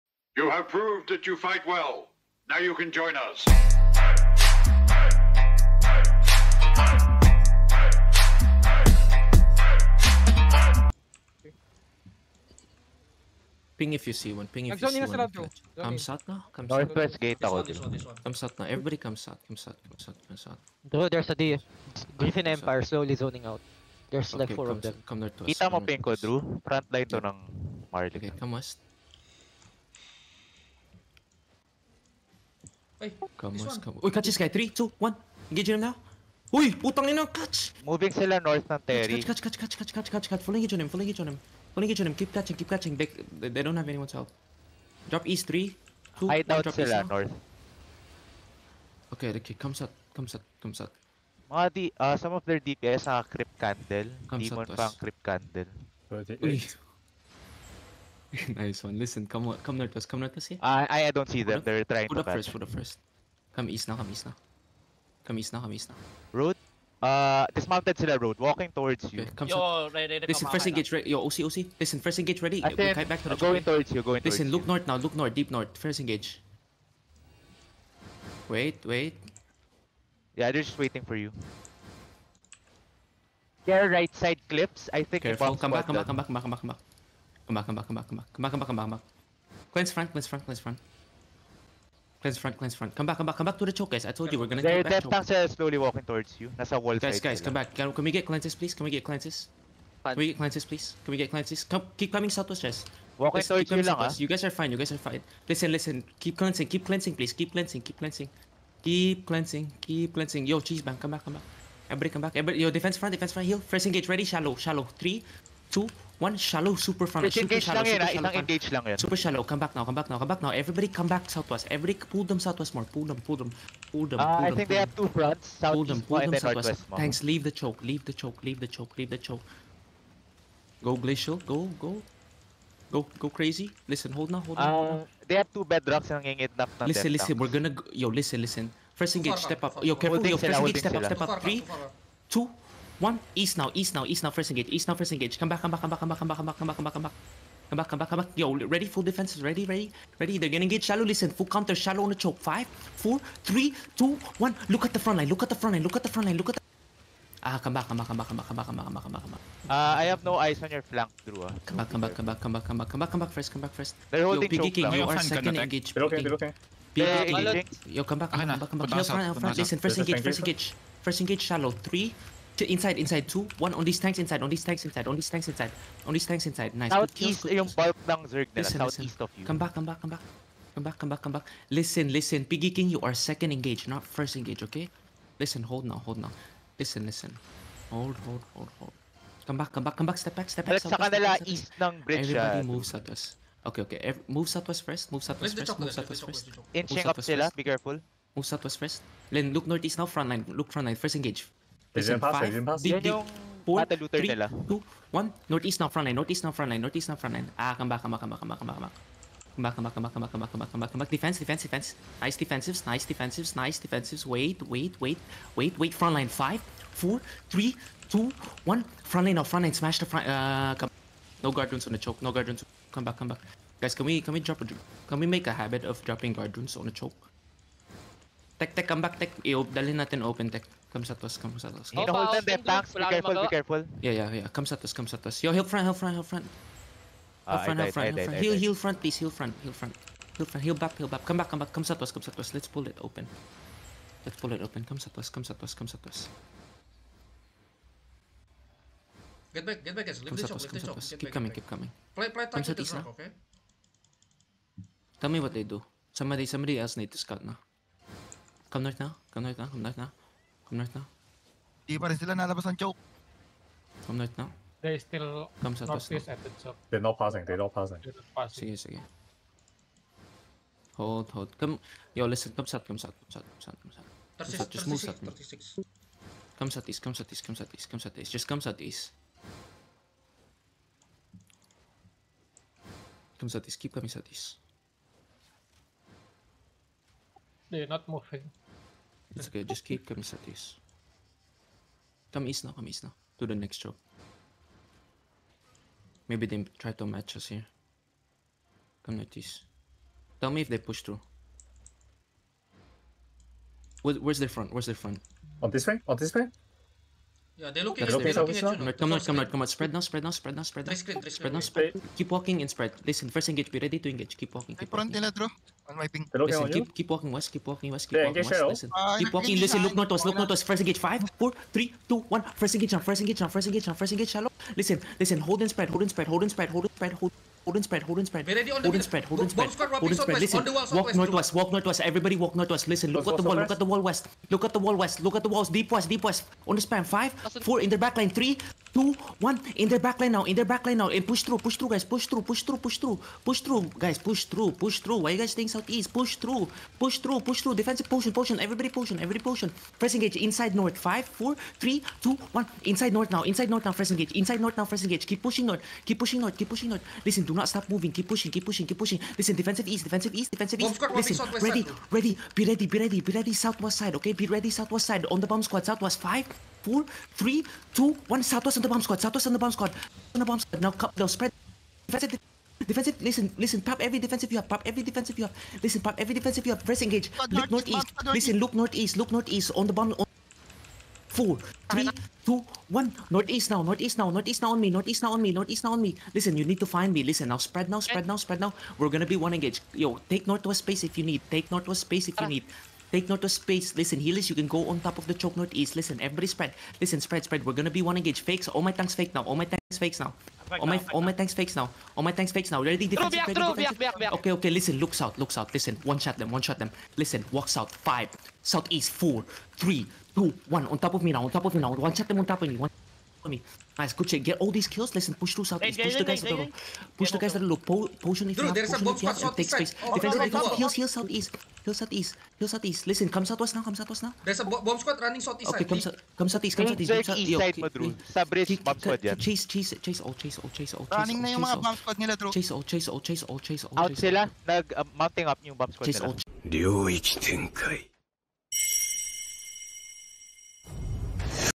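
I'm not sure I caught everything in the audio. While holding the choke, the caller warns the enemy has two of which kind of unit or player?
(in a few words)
bedrocks.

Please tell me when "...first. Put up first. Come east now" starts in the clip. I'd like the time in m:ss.
1:02.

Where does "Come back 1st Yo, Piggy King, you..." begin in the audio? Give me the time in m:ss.
2:43.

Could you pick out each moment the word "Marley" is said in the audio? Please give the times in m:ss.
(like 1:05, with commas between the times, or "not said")
0:27.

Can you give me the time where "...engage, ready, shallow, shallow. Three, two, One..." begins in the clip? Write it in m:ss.
1:53.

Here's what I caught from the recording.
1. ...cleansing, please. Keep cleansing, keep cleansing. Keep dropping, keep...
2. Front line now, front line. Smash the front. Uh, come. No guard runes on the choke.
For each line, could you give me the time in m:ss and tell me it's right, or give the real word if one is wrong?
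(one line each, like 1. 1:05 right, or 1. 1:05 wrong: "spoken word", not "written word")
1. 1:46 wrong: "cleansing", not "dropping"
2. 3:39 right.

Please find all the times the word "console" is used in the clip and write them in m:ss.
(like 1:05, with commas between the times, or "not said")
not said.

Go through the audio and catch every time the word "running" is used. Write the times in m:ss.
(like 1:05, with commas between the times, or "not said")
7:05, 7:11.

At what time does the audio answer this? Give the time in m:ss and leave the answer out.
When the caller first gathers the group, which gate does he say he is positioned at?
0:16.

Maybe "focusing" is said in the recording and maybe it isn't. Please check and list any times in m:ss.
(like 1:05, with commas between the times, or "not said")
not said.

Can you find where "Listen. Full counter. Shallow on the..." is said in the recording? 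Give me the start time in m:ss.
2:31.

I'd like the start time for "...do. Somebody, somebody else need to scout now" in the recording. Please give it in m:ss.
4:15.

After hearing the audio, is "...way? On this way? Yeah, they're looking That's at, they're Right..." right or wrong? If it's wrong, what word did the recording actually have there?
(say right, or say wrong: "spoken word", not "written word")
right.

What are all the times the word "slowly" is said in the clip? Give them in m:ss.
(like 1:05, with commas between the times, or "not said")
0:22, 1:35.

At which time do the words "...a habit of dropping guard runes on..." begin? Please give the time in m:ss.
3:45.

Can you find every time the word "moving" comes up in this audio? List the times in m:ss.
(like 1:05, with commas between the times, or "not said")
0:37, 4:48, 5:57.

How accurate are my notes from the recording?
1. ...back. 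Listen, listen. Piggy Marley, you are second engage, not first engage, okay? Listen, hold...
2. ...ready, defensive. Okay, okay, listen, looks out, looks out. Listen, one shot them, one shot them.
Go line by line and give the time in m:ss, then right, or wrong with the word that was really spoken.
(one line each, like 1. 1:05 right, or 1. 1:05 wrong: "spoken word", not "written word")
1. 3:01 wrong: "King", not "Marley"
2. 6:43 right.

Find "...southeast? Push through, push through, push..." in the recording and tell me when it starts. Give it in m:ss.
5:45.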